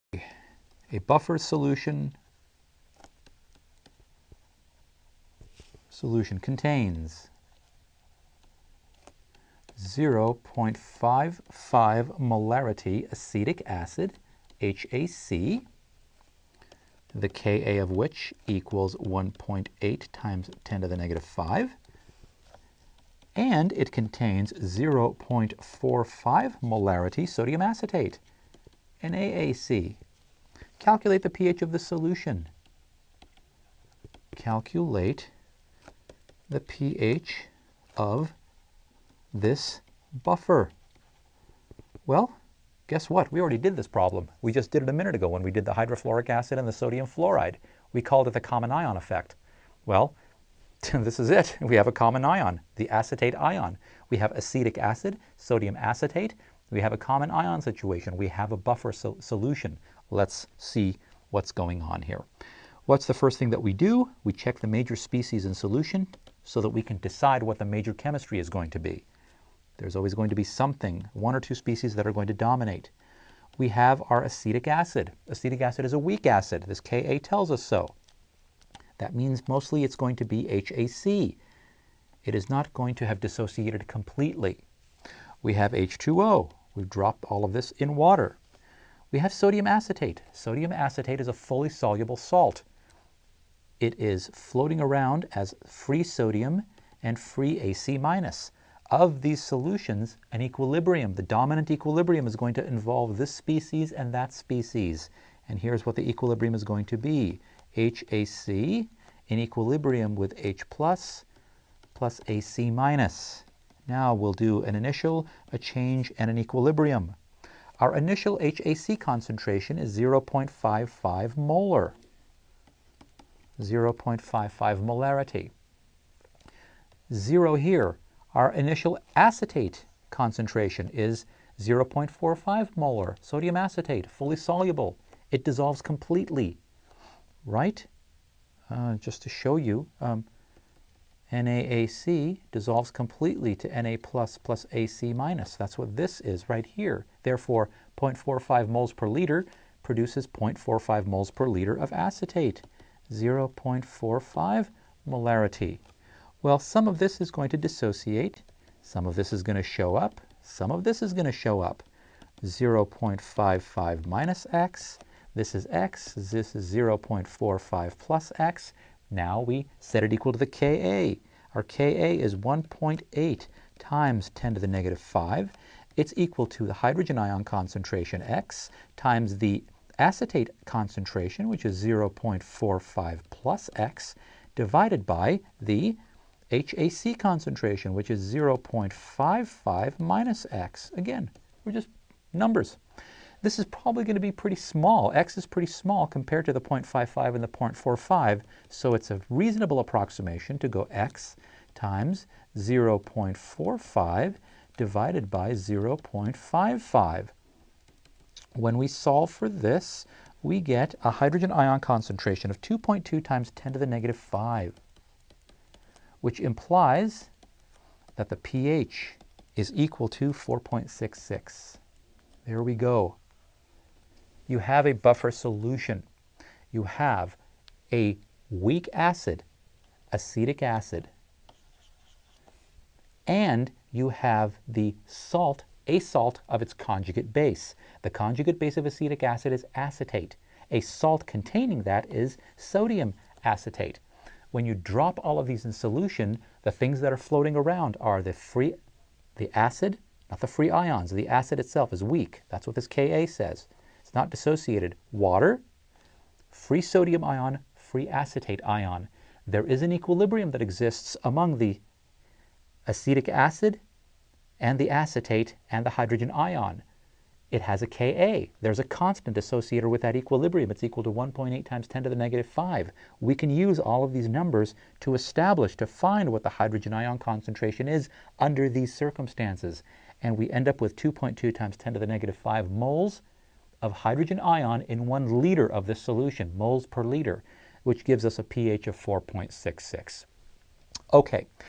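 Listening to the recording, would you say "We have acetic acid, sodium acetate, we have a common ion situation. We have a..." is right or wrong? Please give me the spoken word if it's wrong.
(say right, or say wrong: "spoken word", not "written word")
right.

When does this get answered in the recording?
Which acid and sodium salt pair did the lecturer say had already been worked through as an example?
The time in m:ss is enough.
0:45.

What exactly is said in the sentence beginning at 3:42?
There we go you have a buffer solution.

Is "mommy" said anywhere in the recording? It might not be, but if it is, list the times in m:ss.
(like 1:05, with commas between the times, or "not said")
not said.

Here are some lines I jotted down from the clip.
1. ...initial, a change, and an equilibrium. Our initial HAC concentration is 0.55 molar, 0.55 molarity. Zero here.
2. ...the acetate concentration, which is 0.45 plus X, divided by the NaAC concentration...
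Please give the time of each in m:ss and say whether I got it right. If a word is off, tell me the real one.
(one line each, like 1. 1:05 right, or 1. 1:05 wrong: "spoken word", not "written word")
1. 1:54 right
2. 2:59 wrong: "HAC", not "NaAC".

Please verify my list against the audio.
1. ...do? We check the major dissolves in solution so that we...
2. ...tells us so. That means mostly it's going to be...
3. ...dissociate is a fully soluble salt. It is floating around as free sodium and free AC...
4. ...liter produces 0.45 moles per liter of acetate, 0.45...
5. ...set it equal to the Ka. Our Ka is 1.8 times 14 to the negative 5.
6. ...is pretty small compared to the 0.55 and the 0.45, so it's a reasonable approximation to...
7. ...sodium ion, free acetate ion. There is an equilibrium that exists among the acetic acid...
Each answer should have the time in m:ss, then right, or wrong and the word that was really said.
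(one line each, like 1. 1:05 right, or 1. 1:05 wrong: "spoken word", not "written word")
1. 1:03 wrong: "species", not "dissolves"
2. 1:17 right
3. 1:30 wrong: "acetate", not "dissociate"
4. 2:29 right
5. 2:49 wrong: "10", not "14"
6. 3:15 right
7. 4:16 right.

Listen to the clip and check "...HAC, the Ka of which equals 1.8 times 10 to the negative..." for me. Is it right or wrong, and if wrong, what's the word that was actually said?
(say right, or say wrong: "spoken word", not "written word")
right.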